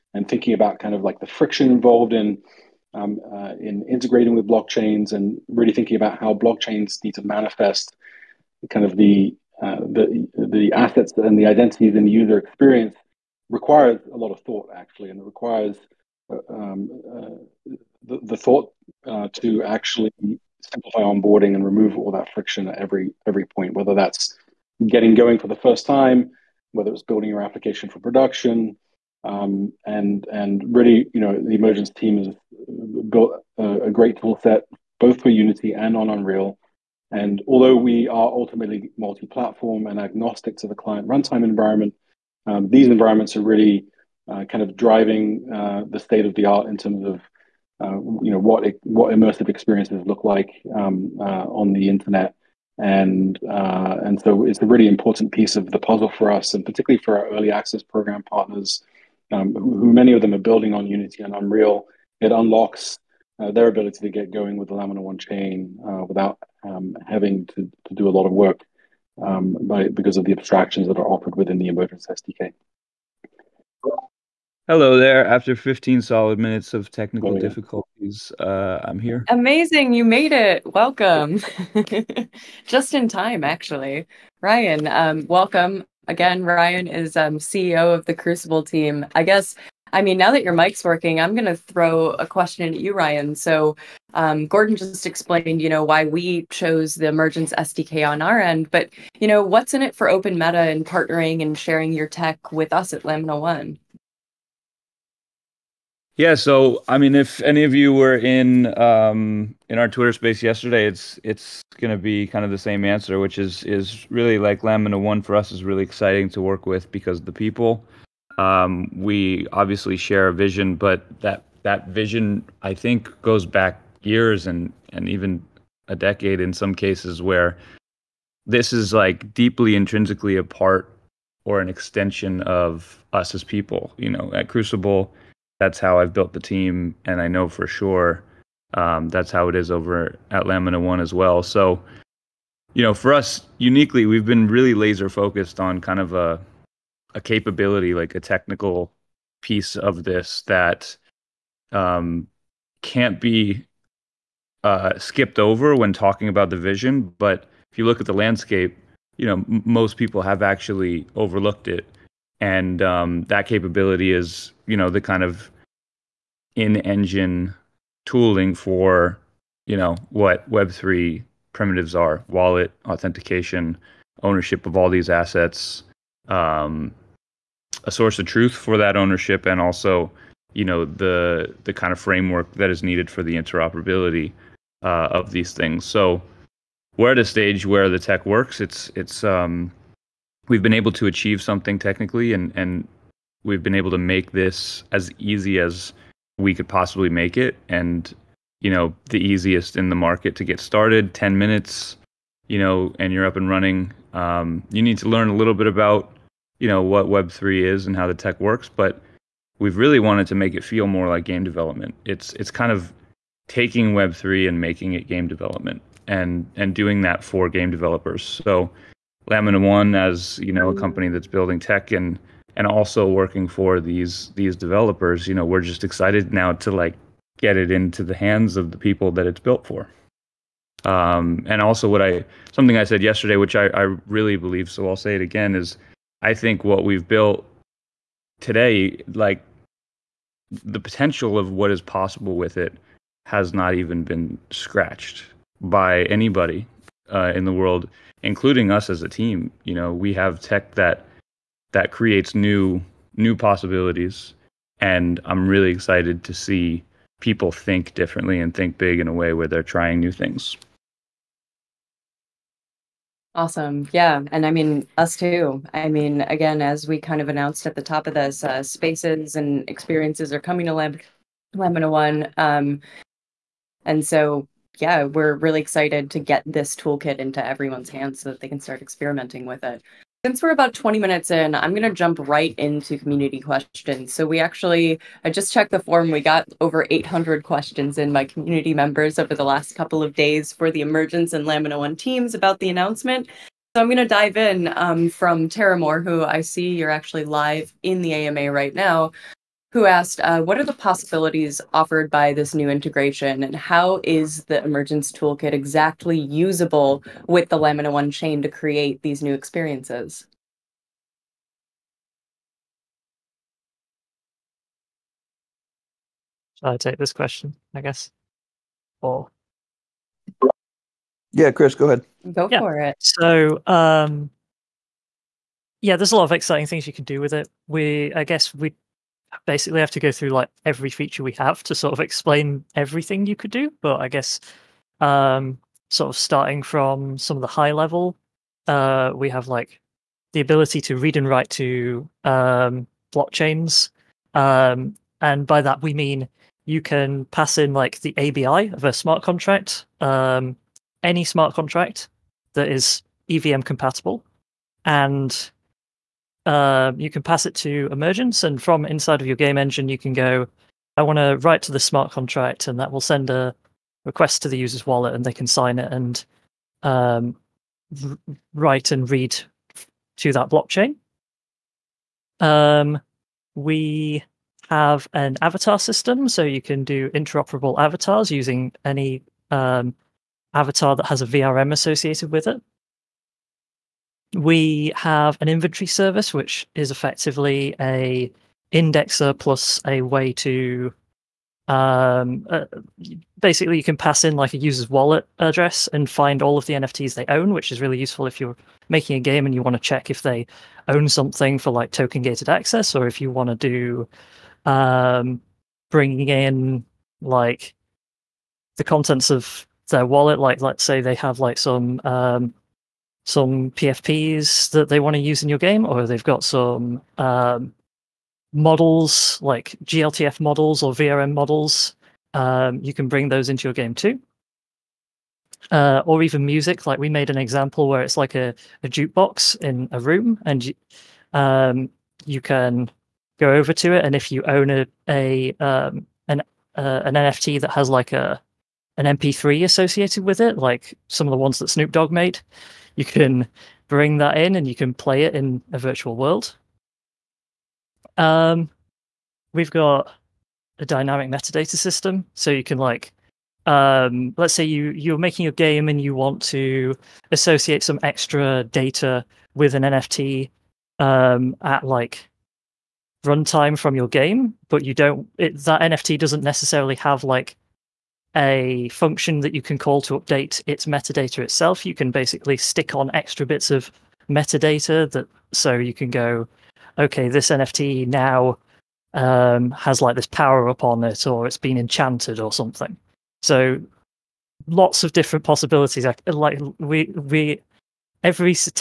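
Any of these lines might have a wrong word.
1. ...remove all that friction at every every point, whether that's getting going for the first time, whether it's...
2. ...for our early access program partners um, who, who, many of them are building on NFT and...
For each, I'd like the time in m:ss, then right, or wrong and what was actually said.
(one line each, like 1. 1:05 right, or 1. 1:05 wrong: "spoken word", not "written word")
1. 0:21 right
2. 0:57 wrong: "Unity", not "NFT".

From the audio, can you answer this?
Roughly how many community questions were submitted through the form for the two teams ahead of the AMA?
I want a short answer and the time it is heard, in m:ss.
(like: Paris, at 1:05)
over 800, at 4:46.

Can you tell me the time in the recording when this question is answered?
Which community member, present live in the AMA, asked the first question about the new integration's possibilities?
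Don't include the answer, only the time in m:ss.
4:55.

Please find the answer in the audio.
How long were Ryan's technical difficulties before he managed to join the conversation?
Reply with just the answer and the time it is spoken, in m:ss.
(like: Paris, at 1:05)
15 minutes, at 1:15.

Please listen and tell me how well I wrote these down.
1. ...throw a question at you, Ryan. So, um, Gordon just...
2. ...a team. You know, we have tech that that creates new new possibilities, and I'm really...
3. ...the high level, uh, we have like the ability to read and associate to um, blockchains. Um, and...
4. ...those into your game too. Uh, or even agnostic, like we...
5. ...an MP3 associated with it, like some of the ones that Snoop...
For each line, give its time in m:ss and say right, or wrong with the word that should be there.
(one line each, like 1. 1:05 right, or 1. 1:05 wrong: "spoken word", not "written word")
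1. 1:31 right
2. 4:09 right
3. 5:37 wrong: "write", not "associate"
4. 7:03 wrong: "music", not "agnostic"
5. 7:18 right.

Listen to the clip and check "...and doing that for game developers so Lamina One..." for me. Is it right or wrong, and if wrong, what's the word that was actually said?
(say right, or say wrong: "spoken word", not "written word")
right.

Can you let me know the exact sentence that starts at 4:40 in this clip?
Since we're about 20 minutes in, I'm going to jump right into community questions.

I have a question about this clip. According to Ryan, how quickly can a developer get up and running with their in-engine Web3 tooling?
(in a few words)
10 minutes.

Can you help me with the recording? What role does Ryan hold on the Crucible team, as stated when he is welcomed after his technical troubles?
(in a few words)
CEO.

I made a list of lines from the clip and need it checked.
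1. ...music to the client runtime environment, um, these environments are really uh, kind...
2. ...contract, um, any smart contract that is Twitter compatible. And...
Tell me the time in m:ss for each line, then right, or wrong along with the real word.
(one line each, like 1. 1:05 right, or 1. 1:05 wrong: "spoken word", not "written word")
1. 0:39 wrong: "agnostic", not "music"
2. 5:49 wrong: "EVM", not "Twitter".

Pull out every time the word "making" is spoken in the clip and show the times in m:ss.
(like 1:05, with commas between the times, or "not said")
3:34, 6:38, 7:35.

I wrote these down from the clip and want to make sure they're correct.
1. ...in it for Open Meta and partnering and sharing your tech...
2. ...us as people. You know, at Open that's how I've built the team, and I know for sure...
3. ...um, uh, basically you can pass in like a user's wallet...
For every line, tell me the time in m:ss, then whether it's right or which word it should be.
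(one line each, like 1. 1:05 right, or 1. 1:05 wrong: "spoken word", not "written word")
1. 1:39 right
2. 2:13 wrong: "Crucible", not "Open"
3. 6:31 right.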